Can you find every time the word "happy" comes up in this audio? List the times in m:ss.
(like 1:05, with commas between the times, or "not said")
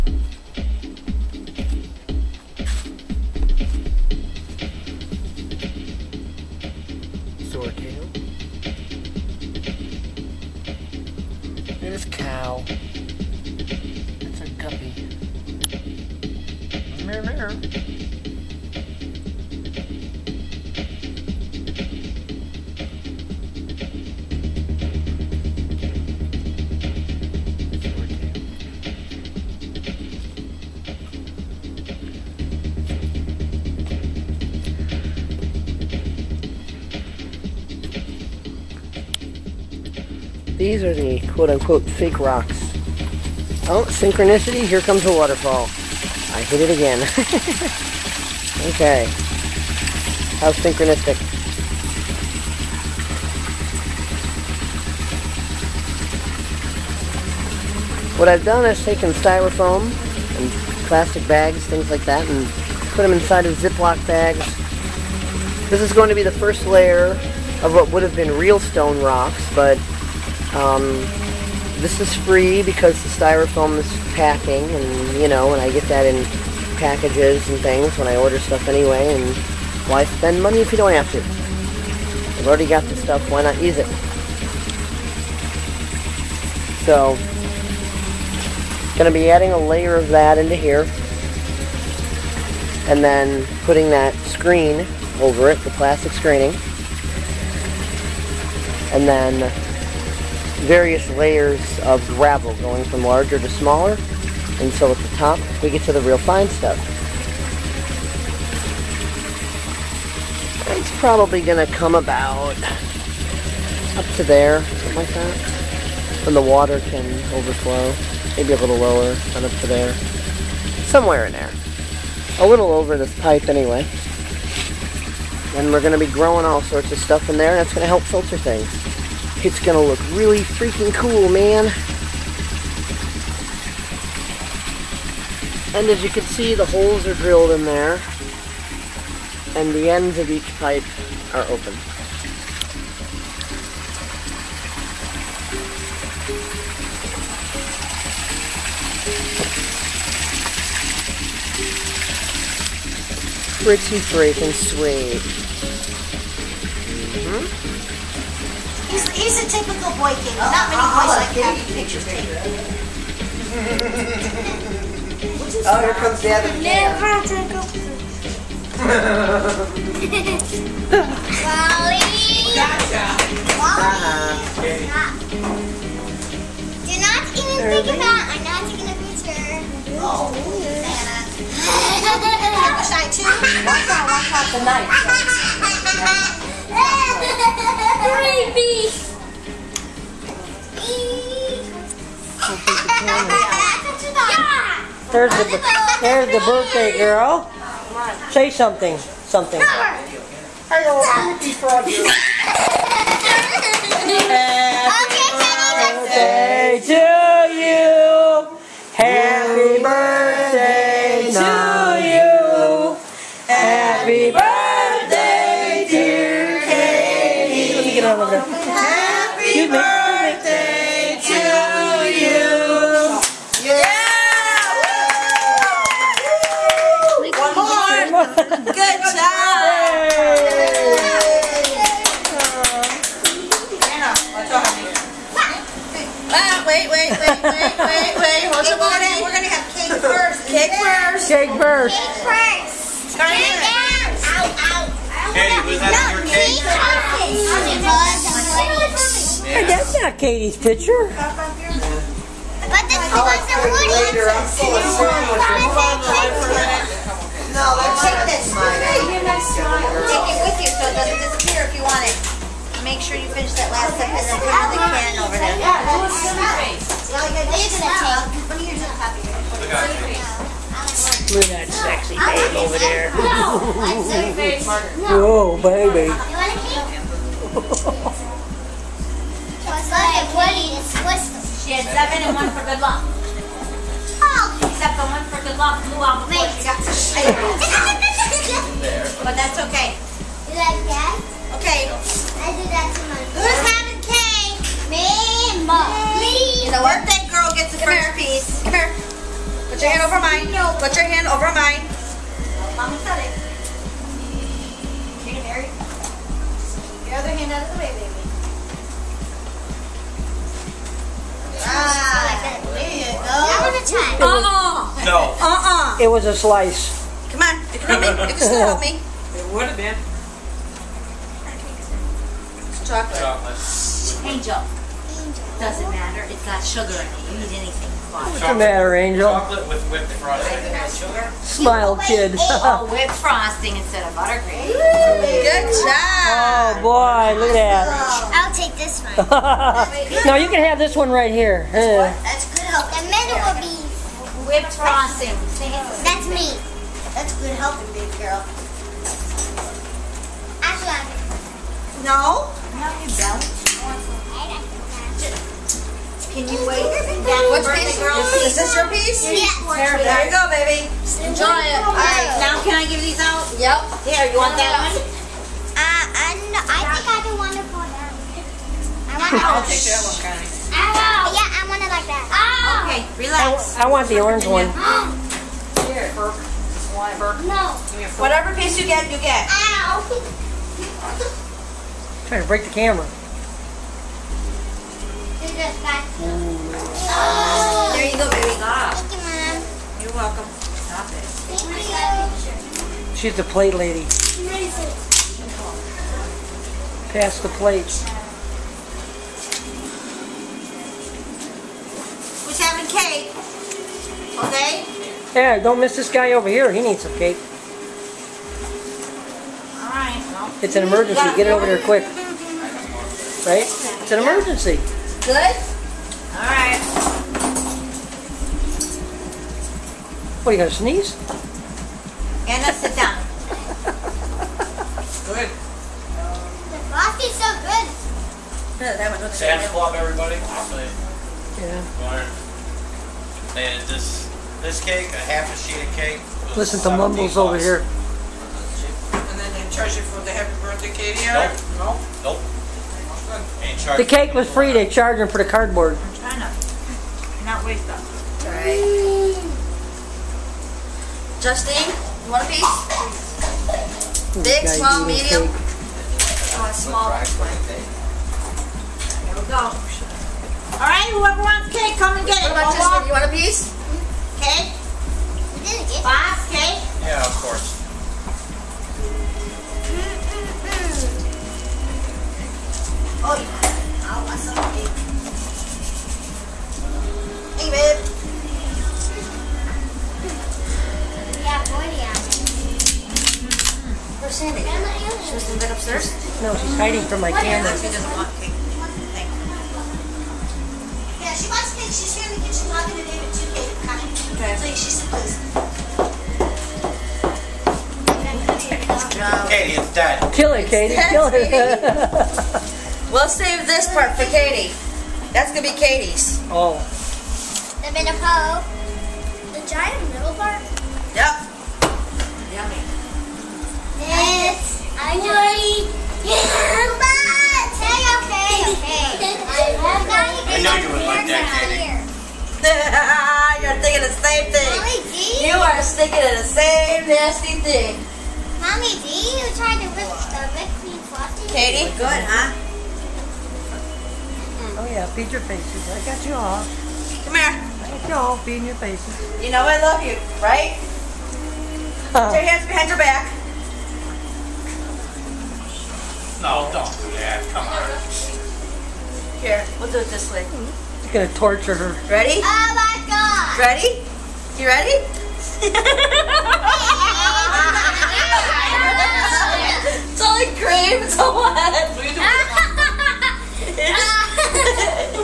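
3:21, 3:28, 7:20.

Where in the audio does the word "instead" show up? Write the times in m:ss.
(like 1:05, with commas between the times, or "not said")
5:33.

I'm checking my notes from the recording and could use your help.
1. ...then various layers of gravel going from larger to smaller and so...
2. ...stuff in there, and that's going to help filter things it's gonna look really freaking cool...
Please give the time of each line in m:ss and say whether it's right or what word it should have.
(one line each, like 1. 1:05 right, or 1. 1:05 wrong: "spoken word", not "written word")
1. 1:39 right
2. 2:06 right.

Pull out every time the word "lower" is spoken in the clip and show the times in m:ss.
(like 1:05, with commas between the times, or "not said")
1:58.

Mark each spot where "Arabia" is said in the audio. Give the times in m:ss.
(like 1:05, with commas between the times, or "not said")
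not said.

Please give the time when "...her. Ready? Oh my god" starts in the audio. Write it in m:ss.
9:11.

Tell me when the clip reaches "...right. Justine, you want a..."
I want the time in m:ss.
7:28.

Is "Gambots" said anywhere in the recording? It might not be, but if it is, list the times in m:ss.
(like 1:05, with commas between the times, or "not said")
8:36.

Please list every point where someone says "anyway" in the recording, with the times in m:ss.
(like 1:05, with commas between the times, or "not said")
1:18, 2:03.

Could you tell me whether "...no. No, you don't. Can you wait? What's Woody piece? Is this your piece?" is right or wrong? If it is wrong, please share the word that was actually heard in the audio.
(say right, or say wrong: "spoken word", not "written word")
wrong: "Which", not "Woody".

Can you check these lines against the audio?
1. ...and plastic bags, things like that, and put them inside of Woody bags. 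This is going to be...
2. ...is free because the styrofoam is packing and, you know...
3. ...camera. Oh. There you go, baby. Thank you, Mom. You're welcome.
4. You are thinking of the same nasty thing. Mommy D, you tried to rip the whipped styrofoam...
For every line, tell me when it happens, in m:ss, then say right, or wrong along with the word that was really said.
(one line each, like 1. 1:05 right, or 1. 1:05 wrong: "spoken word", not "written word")
1. 1:00 wrong: "Ziploc", not "Woody"
2. 1:11 right
3. 6:22 right
4. 8:45 wrong: "cream", not "styrofoam".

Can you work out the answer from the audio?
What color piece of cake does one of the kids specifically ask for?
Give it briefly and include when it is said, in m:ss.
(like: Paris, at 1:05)
orange, at 6:14.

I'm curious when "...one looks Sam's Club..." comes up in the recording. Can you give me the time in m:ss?
7:09.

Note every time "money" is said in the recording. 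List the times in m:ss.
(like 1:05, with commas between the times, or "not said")
1:20.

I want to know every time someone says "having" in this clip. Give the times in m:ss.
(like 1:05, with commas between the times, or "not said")
4:53, 6:42.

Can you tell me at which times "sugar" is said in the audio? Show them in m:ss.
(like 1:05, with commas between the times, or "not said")
5:26, 5:31.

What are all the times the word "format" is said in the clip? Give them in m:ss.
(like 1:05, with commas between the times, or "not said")
not said.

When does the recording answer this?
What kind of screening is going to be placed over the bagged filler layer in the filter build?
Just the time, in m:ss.
1:35.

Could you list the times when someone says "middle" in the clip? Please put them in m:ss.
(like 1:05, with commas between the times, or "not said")
5:43, 8:30.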